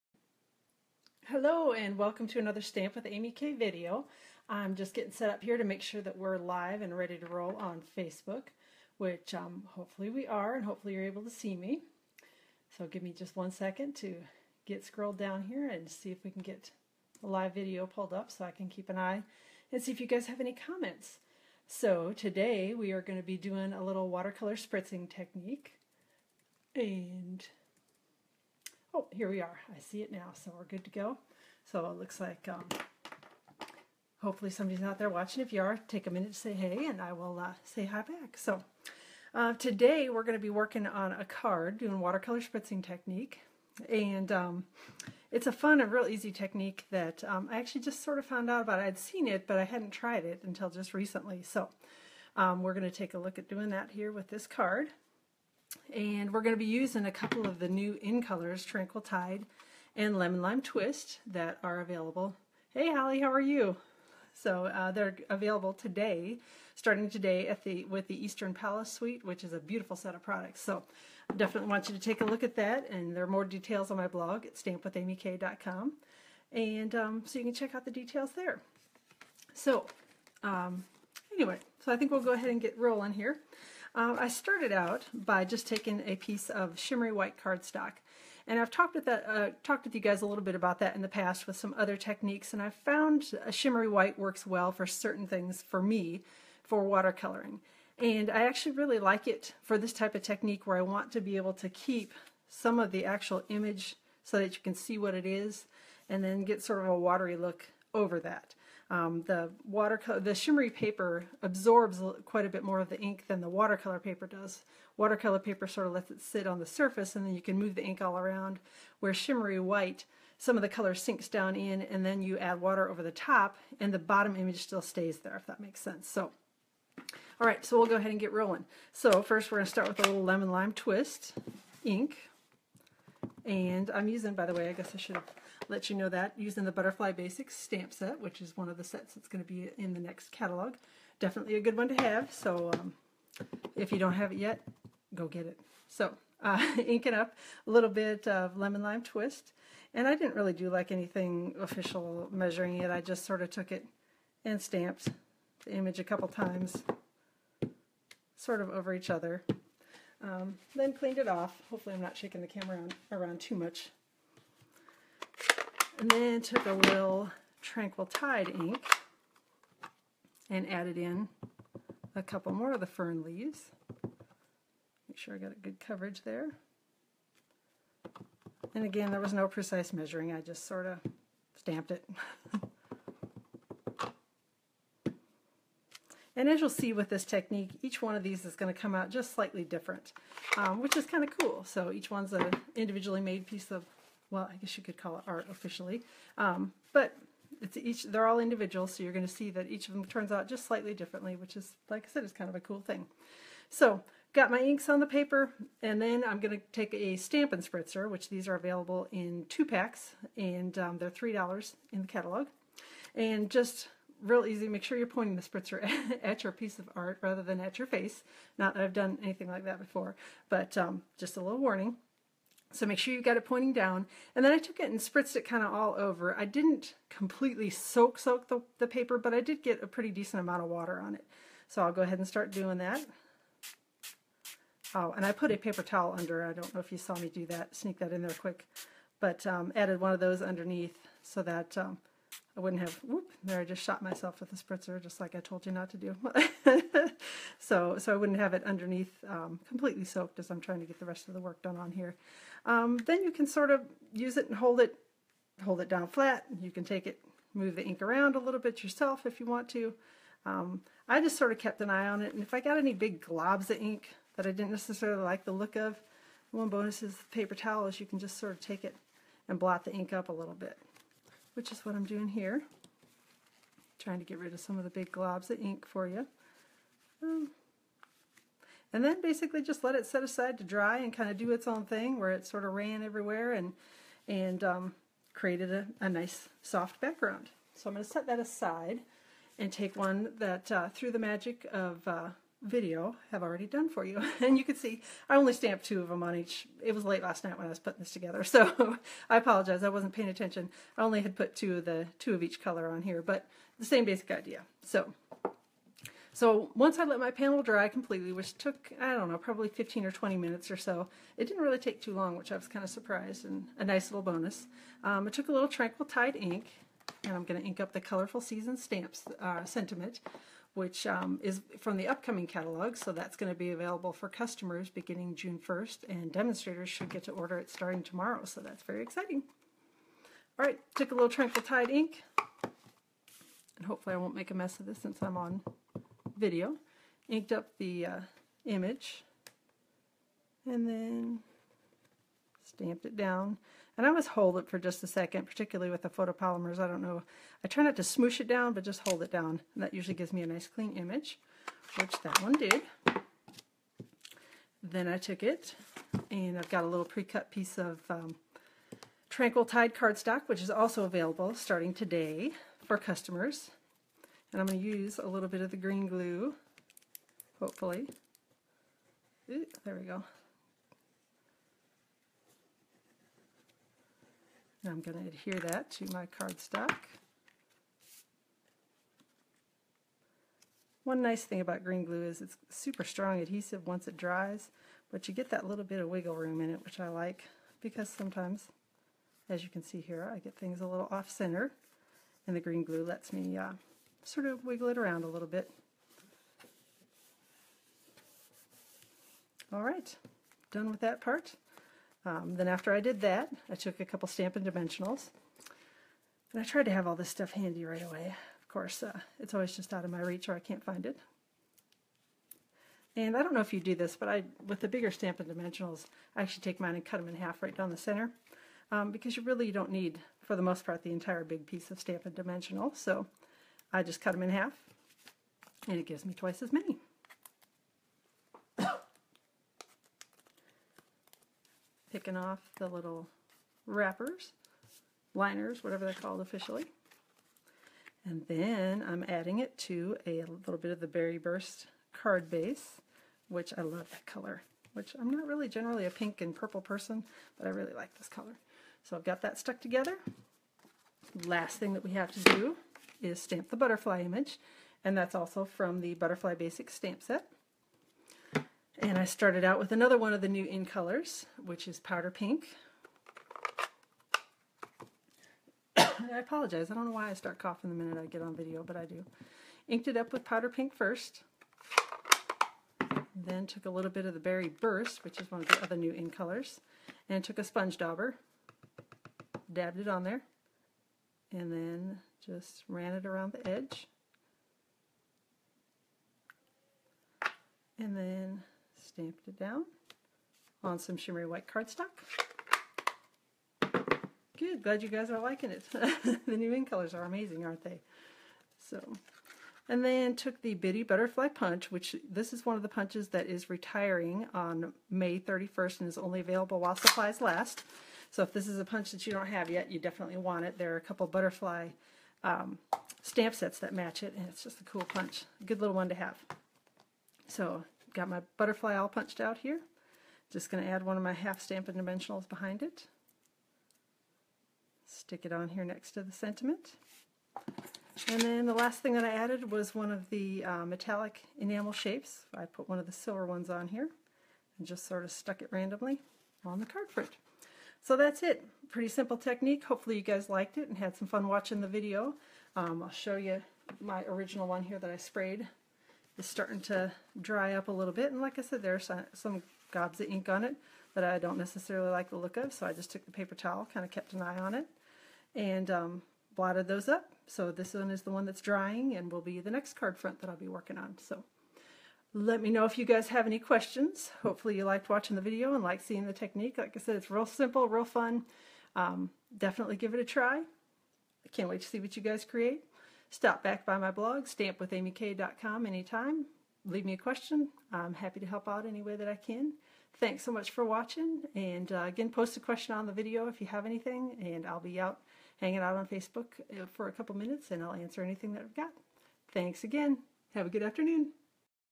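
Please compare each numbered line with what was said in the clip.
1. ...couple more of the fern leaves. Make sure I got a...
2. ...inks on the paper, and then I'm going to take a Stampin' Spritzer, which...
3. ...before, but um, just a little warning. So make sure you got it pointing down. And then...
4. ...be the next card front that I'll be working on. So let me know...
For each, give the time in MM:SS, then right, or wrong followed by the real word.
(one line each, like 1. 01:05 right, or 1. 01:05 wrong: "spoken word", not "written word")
1. 02:52 right
2. 03:24 right
3. 03:39 right
4. 09:19 right.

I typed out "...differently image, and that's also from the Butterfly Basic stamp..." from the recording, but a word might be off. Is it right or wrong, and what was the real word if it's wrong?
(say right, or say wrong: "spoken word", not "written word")
wrong: "butterfly", not "differently".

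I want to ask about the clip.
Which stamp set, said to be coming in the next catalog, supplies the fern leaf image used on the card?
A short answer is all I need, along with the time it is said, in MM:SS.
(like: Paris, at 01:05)
Butterfly Basics, at 02:16.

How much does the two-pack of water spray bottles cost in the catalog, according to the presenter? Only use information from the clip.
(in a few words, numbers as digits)
$3.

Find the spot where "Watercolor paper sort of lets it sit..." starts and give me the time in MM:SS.
01:54.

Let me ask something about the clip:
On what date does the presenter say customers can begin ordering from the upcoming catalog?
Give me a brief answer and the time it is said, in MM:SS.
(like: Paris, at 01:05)
June 1st, at 05:25.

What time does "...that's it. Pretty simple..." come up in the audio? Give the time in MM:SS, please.
08:58.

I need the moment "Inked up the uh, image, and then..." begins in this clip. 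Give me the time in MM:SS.
05:37.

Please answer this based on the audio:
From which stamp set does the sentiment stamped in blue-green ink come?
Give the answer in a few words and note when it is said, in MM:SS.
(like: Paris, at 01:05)
Colorful Season, at 05:17.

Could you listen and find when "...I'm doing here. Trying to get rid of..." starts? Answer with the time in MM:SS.
04:31.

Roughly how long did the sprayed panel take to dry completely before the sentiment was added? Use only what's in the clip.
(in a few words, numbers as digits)
15 or 20 minutes.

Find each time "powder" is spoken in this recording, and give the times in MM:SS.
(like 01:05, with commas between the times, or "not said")
07:41, 07:50.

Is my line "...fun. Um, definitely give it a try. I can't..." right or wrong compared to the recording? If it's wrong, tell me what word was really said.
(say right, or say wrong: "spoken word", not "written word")
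right.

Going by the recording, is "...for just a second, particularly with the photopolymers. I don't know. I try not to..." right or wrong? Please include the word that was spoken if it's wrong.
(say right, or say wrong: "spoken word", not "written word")
right.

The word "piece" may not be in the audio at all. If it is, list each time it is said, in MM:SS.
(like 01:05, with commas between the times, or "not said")
01:26, 03:13, 03:36, 05:57, 07:01.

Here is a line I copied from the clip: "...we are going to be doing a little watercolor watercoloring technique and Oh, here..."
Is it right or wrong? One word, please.
wrong.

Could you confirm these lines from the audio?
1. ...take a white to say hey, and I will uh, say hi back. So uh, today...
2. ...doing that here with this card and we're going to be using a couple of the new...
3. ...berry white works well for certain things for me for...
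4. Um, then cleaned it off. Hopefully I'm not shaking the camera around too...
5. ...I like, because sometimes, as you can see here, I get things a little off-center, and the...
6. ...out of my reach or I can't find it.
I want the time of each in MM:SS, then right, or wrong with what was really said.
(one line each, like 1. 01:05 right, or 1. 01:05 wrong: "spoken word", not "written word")
1. 00:35 wrong: "minute", not "white"
2. 00:53 right
3. 01:33 wrong: "shimmery", not "berry"
4. 02:40 right
5. 06:26 right
6. 06:49 right.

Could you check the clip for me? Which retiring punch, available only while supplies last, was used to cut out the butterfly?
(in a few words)
Bitty Butterfly Punch.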